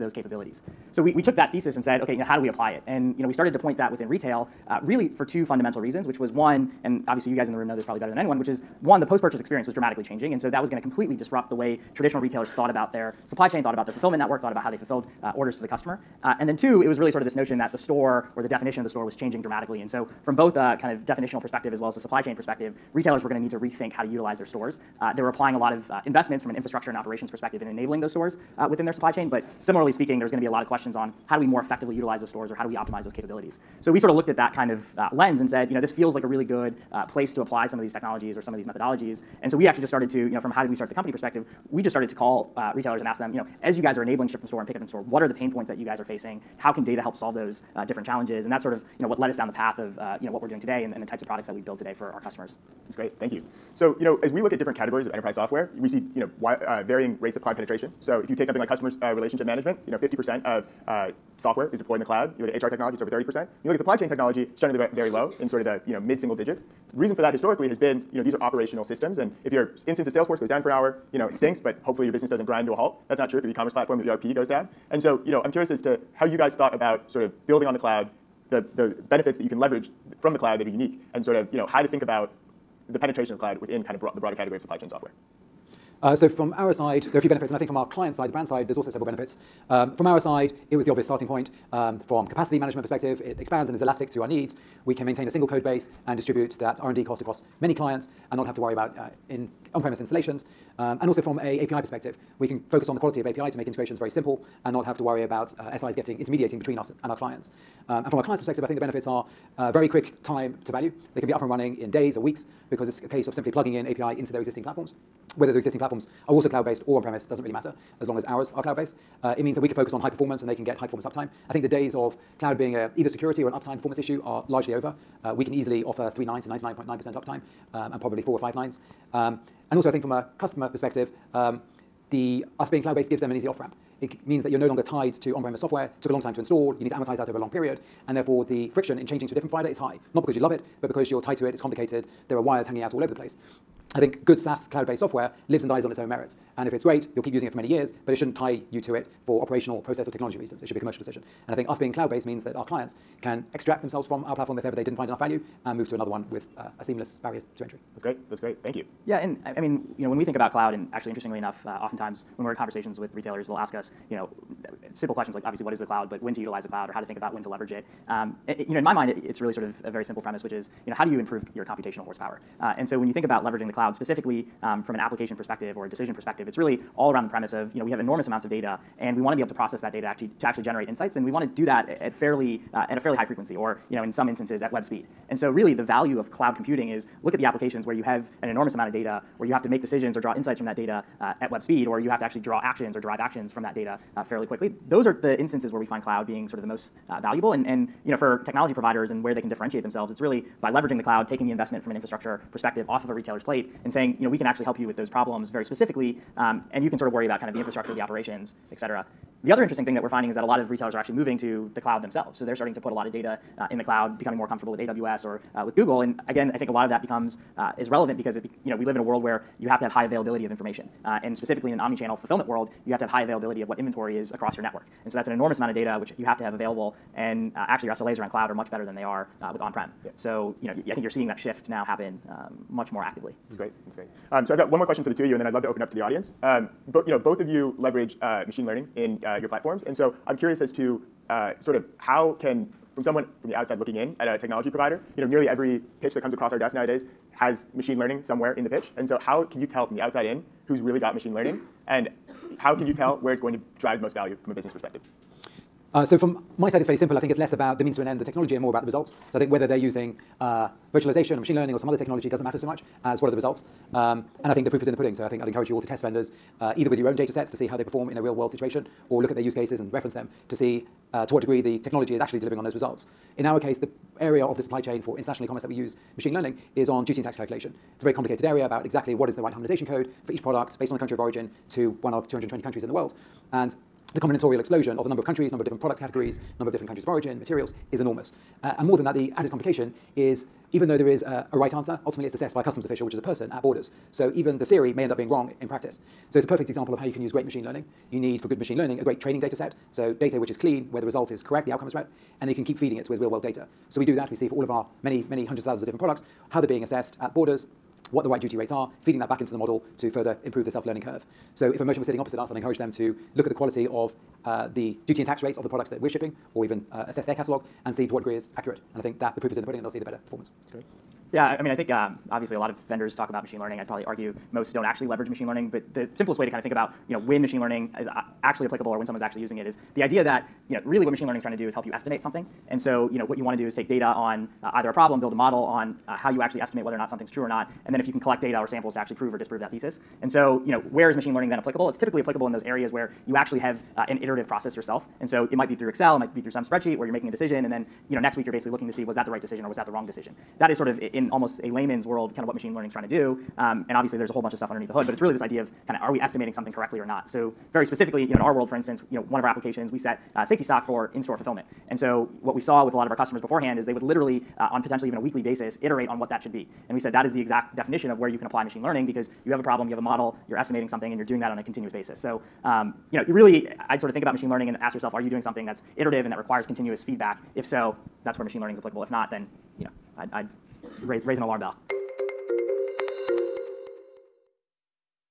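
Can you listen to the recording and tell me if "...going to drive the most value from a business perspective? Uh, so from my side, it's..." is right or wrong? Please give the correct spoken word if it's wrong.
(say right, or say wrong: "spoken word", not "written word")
right.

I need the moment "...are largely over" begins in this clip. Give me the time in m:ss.
2:04.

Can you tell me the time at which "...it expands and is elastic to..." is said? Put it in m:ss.
1:33.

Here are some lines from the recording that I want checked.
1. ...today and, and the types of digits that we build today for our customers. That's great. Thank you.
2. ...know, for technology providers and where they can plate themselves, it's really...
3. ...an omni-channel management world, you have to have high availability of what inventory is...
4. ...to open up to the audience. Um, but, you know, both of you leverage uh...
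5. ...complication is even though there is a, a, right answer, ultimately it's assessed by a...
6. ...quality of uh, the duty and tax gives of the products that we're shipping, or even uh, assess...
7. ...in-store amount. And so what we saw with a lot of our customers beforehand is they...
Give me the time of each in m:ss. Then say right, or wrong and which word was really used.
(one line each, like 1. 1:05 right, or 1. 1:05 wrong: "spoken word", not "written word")
1. 0:50 wrong: "products", not "digits"
2. 3:18 wrong: "differentiate", not "plate"
3. 3:41 wrong: "fulfillment", not "management"
4. 3:55 right
5. 4:49 right
6. 5:13 wrong: "rates", not "gives"
7. 6:01 wrong: "fulfillment", not "amount".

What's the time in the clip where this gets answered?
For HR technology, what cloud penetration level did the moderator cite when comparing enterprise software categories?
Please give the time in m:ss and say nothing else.
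1:03.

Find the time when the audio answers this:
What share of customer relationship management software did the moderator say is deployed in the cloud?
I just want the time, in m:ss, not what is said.
0:59.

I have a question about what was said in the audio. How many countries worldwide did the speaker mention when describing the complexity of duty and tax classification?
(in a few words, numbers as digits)
220.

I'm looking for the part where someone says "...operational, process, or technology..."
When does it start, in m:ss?
2:29.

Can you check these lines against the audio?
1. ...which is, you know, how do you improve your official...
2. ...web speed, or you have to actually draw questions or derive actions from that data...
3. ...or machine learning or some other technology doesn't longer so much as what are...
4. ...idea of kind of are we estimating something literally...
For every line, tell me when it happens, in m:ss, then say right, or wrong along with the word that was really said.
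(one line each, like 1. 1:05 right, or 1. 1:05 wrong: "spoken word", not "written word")
1. 2:50 wrong: "computational", not "official"
2. 3:11 wrong: "actions", not "questions"
3. 4:21 wrong: "matter", not "longer"
4. 5:55 wrong: "correctly", not "literally".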